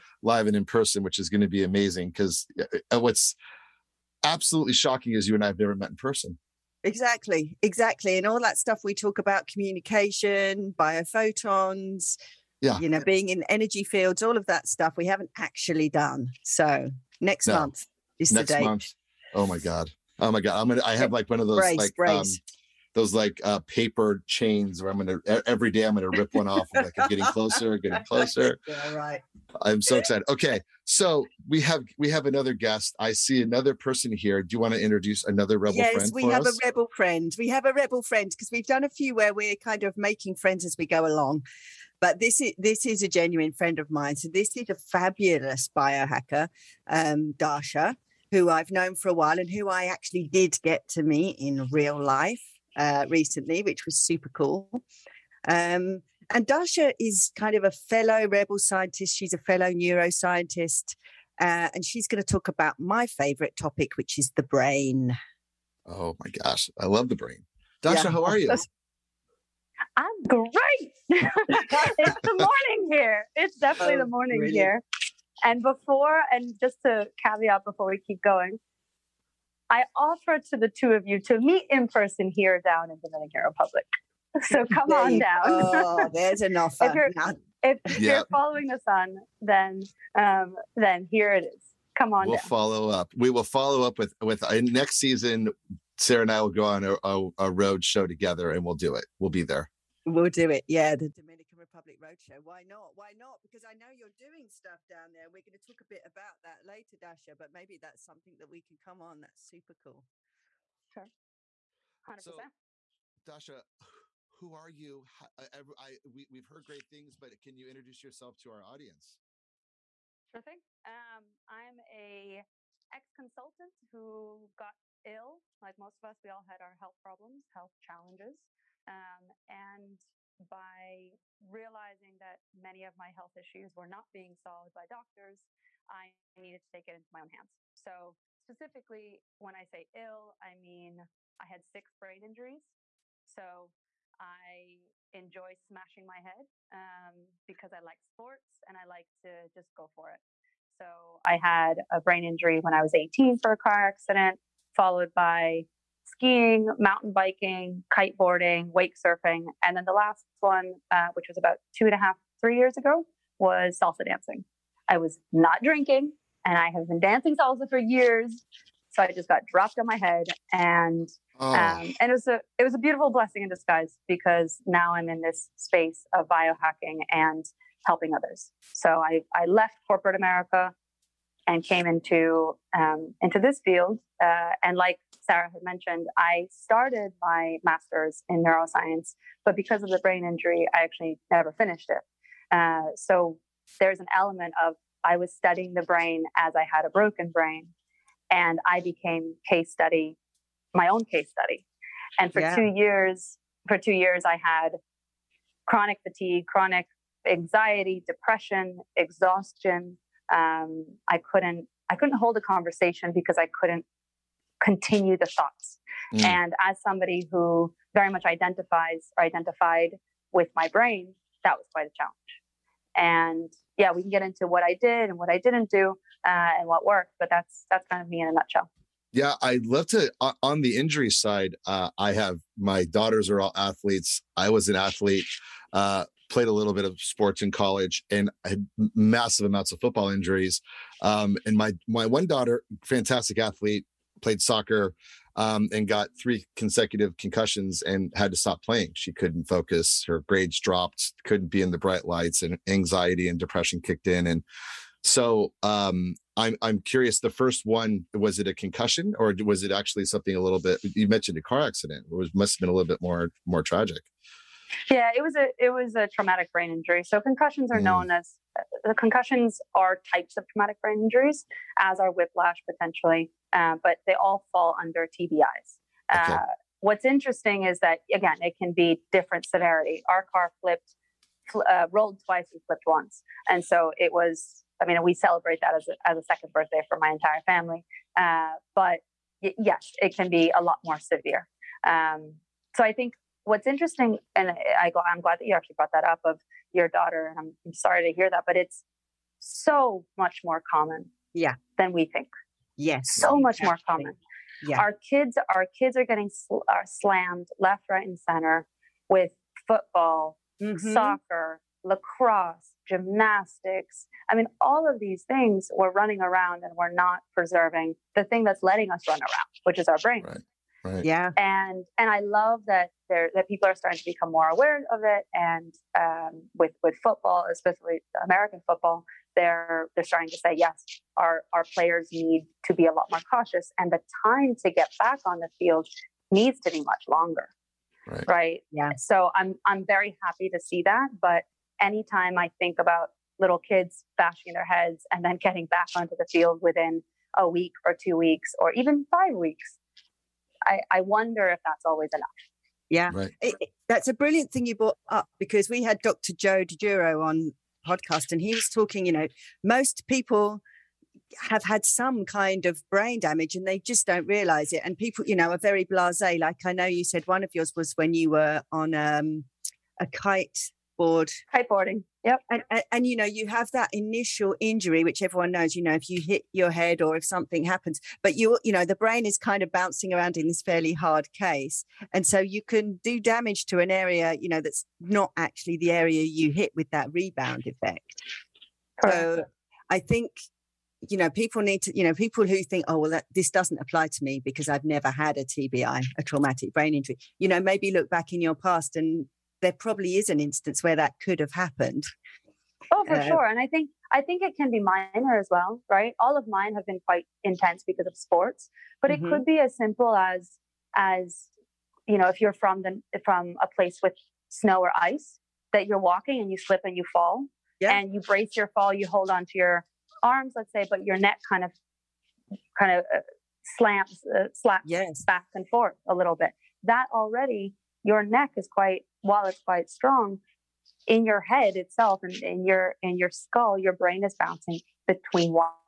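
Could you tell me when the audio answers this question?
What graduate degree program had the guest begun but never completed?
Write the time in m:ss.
3:07.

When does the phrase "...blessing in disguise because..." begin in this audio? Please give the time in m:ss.
2:53.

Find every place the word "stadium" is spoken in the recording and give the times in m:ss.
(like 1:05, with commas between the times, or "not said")
not said.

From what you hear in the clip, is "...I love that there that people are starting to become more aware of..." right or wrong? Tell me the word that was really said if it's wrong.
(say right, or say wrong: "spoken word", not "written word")
right.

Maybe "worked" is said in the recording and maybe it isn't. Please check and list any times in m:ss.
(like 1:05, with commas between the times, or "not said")
3:46.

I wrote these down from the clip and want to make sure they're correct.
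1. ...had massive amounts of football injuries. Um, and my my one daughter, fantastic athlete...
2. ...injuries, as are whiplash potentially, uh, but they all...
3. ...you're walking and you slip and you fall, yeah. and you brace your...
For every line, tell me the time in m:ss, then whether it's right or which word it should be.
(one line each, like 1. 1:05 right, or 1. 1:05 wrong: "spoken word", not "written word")
1. 3:58 right
2. 4:31 right
3. 6:55 right.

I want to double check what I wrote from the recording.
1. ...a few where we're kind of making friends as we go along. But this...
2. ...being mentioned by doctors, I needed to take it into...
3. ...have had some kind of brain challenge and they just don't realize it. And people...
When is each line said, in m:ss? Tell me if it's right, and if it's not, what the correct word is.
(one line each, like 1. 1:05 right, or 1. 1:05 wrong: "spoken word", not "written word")
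1. 0:38 right
2. 2:14 wrong: "solved", not "mentioned"
3. 6:01 wrong: "damage", not "challenge".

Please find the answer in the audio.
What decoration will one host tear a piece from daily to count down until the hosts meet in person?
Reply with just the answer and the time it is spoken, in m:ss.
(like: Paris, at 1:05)
paper chains, at 0:23.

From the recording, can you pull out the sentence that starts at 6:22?
And so you can do damage to an area, you know, that's not actually the area you hit with that rebound effect.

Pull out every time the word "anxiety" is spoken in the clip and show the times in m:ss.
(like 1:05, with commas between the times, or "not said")
3:27, 4:12.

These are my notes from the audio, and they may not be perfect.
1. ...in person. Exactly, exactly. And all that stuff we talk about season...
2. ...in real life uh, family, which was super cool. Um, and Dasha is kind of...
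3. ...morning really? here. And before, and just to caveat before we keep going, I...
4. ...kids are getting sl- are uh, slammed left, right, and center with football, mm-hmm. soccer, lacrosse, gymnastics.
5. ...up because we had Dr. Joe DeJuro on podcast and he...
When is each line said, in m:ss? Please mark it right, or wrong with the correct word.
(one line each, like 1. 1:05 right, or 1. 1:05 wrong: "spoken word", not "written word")
1. 0:05 wrong: "communication", not "season"
2. 0:51 wrong: "recently", not "family"
3. 1:14 right
4. 5:05 right
5. 5:55 right.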